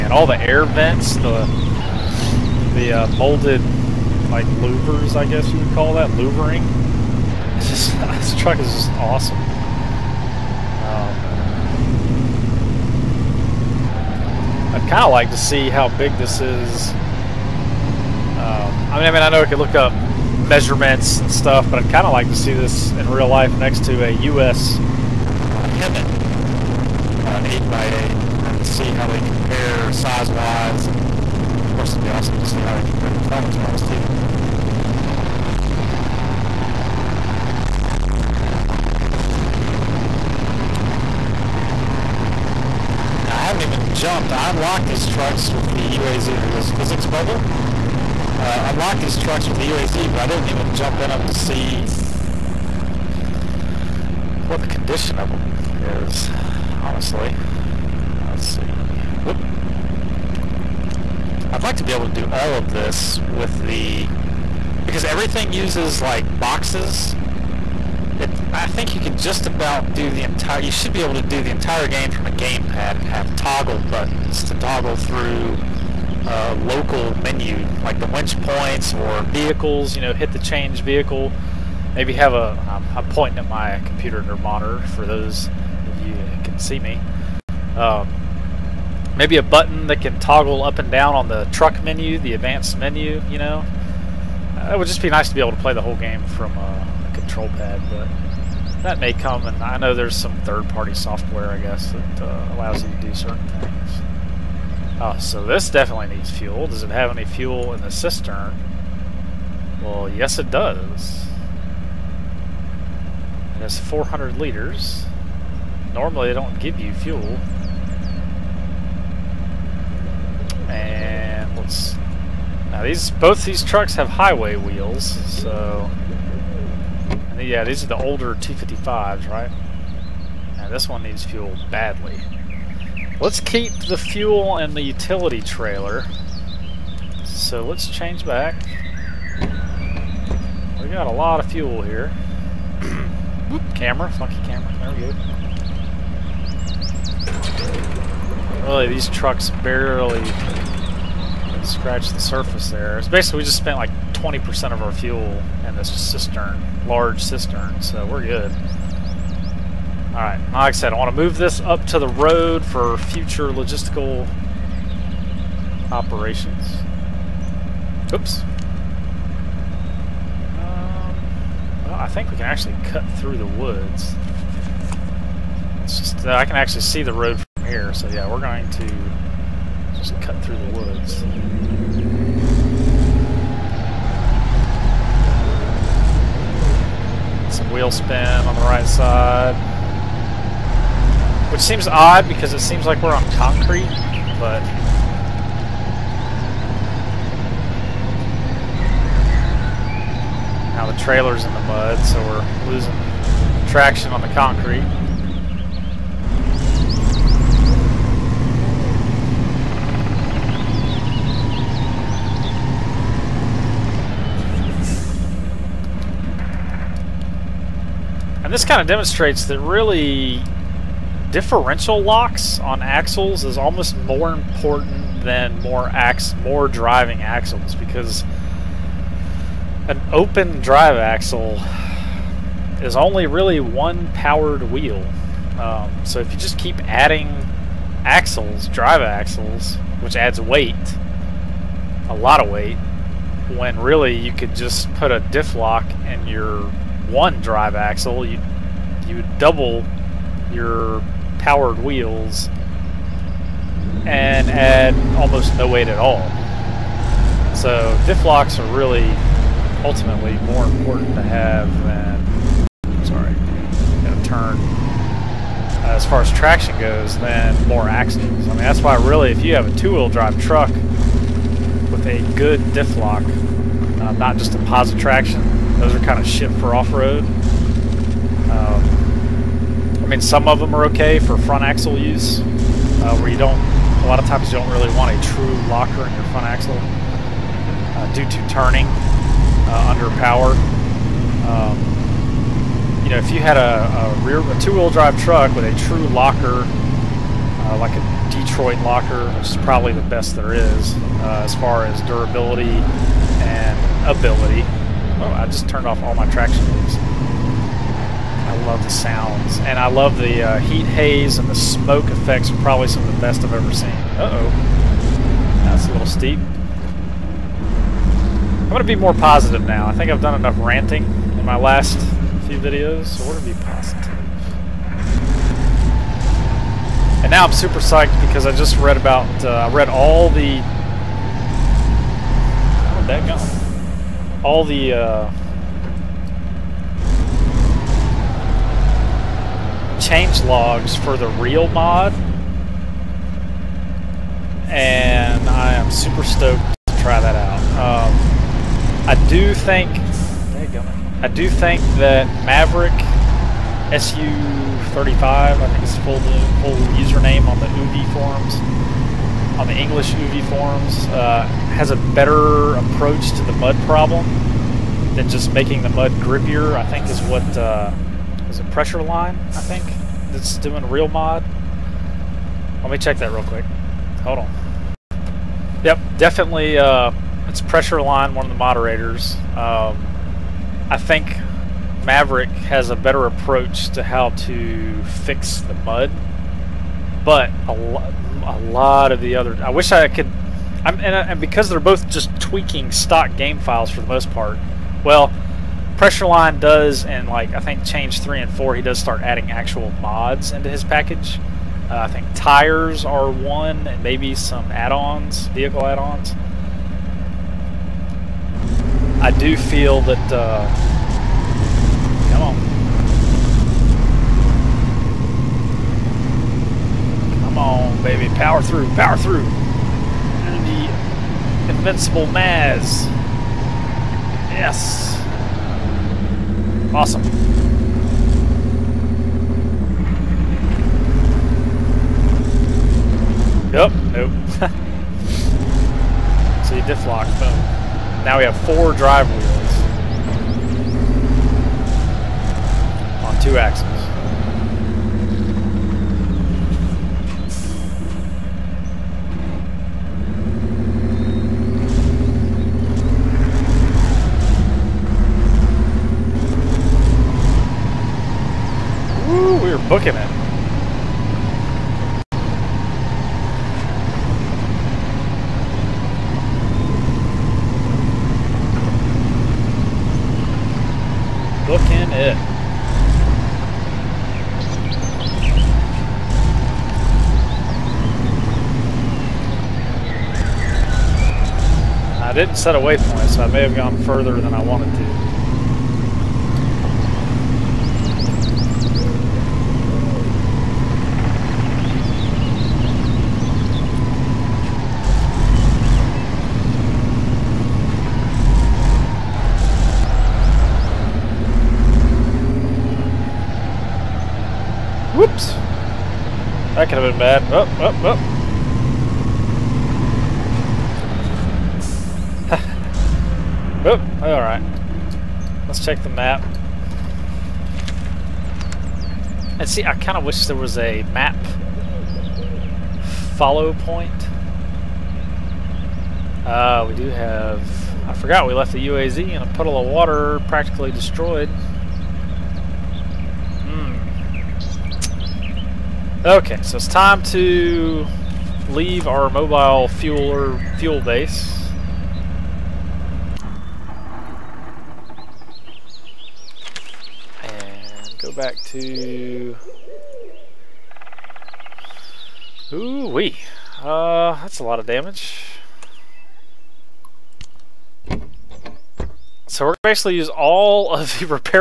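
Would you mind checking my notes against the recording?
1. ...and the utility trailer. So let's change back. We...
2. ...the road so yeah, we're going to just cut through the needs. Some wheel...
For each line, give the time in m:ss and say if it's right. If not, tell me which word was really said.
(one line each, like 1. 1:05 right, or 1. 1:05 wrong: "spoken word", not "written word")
1. 2:14 right
2. 2:57 wrong: "woods", not "needs".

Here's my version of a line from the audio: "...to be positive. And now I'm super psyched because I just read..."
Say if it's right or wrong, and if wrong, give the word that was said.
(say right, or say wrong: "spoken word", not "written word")
right.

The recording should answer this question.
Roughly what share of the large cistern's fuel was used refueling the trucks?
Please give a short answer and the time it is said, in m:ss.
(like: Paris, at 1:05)
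20%, at 2:34.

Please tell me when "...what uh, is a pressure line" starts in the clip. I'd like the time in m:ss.
6:07.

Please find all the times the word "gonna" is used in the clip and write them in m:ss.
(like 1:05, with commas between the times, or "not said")
4:24.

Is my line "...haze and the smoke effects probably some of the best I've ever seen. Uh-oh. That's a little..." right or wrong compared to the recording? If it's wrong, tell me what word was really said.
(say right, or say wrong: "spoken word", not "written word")
right.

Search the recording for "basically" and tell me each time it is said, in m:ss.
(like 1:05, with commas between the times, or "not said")
2:33, 9:19.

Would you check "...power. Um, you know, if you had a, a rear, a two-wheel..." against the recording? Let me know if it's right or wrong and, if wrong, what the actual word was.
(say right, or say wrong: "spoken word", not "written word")
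right.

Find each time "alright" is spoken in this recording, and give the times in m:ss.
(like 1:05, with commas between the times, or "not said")
2:40, 8:34.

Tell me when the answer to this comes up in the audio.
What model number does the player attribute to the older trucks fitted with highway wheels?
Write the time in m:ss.
2:08.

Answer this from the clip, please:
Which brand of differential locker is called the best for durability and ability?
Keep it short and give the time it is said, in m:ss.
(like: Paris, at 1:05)
Detroit locker, at 4:58.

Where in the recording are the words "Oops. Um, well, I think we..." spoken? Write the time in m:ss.
2:48.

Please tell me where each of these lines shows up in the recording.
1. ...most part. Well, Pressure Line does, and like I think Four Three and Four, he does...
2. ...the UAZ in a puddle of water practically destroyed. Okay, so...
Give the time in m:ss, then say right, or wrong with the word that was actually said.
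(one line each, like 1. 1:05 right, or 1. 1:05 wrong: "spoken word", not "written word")
1. 6:34 wrong: "Change", not "Four"
2. 8:48 right.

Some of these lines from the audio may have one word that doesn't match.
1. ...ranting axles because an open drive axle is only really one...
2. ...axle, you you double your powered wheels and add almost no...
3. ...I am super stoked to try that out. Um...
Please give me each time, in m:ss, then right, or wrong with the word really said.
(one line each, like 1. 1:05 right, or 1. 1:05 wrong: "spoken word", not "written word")
1. 3:46 wrong: "driving", not "ranting"
2. 4:07 right
3. 5:45 right.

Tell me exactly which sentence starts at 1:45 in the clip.
Uh, so this definitely needs fuel.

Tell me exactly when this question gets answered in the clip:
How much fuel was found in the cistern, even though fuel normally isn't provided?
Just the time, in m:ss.
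1:53.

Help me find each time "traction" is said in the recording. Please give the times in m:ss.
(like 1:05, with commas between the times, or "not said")
3:23, 4:26, 4:34, 5:06.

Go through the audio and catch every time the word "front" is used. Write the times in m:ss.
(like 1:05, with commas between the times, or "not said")
4:41, 4:46.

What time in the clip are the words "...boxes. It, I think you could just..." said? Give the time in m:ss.
1:06.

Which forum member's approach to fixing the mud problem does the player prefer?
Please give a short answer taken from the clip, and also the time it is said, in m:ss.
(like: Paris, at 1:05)
Maverick SU35, at 5:52.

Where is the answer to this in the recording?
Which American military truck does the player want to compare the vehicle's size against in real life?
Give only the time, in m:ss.
0:25.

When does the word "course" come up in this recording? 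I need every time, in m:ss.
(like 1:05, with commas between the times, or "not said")
0:31.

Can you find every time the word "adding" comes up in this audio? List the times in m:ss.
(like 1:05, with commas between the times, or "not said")
3:56, 6:39.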